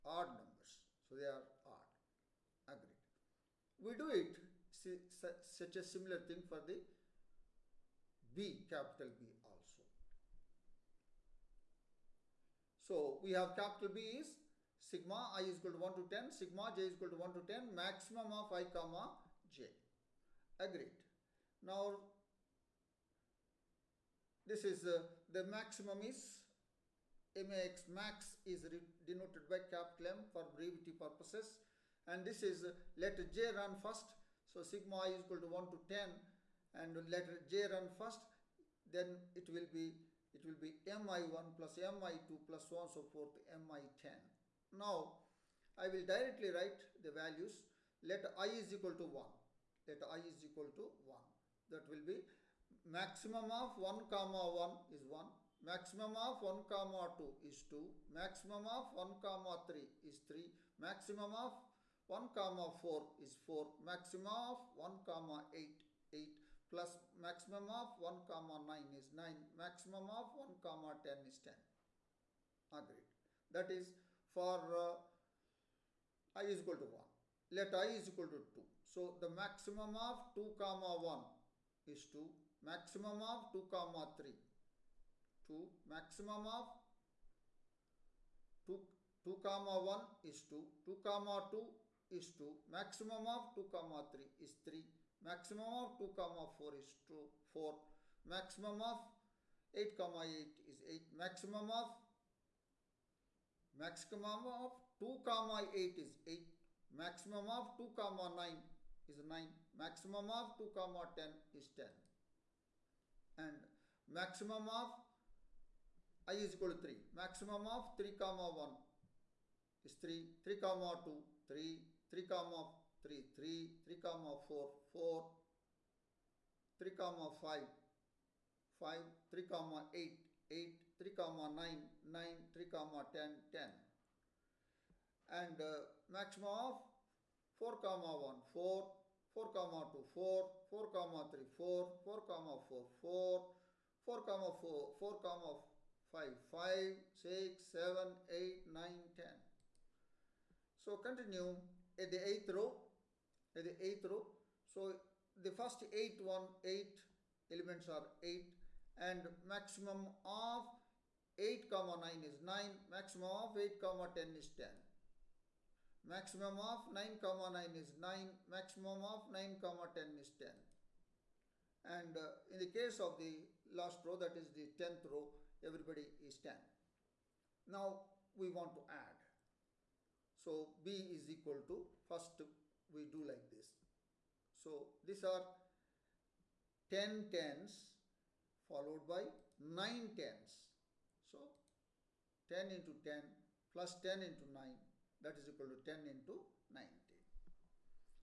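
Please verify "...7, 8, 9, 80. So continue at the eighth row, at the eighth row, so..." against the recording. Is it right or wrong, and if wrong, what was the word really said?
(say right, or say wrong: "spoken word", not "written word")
wrong: "10", not "80".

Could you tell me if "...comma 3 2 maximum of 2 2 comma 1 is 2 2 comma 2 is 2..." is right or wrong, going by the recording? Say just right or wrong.
right.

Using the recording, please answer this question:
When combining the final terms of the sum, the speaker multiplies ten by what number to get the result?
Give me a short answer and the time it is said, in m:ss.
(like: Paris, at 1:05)
19, at 3:15.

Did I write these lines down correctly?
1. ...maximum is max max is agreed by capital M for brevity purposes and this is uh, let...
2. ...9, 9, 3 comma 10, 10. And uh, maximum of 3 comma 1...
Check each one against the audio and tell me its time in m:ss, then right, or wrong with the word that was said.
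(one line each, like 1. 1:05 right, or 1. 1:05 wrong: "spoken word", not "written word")
1. 0:25 wrong: "denoted", not "agreed"
2. 2:11 wrong: "4", not "3".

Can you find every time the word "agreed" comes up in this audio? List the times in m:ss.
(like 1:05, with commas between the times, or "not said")
0:02, 0:20, 1:12.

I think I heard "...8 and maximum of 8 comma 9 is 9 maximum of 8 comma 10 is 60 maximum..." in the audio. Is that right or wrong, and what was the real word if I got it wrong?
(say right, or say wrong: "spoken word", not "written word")
wrong: "10", not "60".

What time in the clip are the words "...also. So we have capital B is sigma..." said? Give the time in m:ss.
0:09.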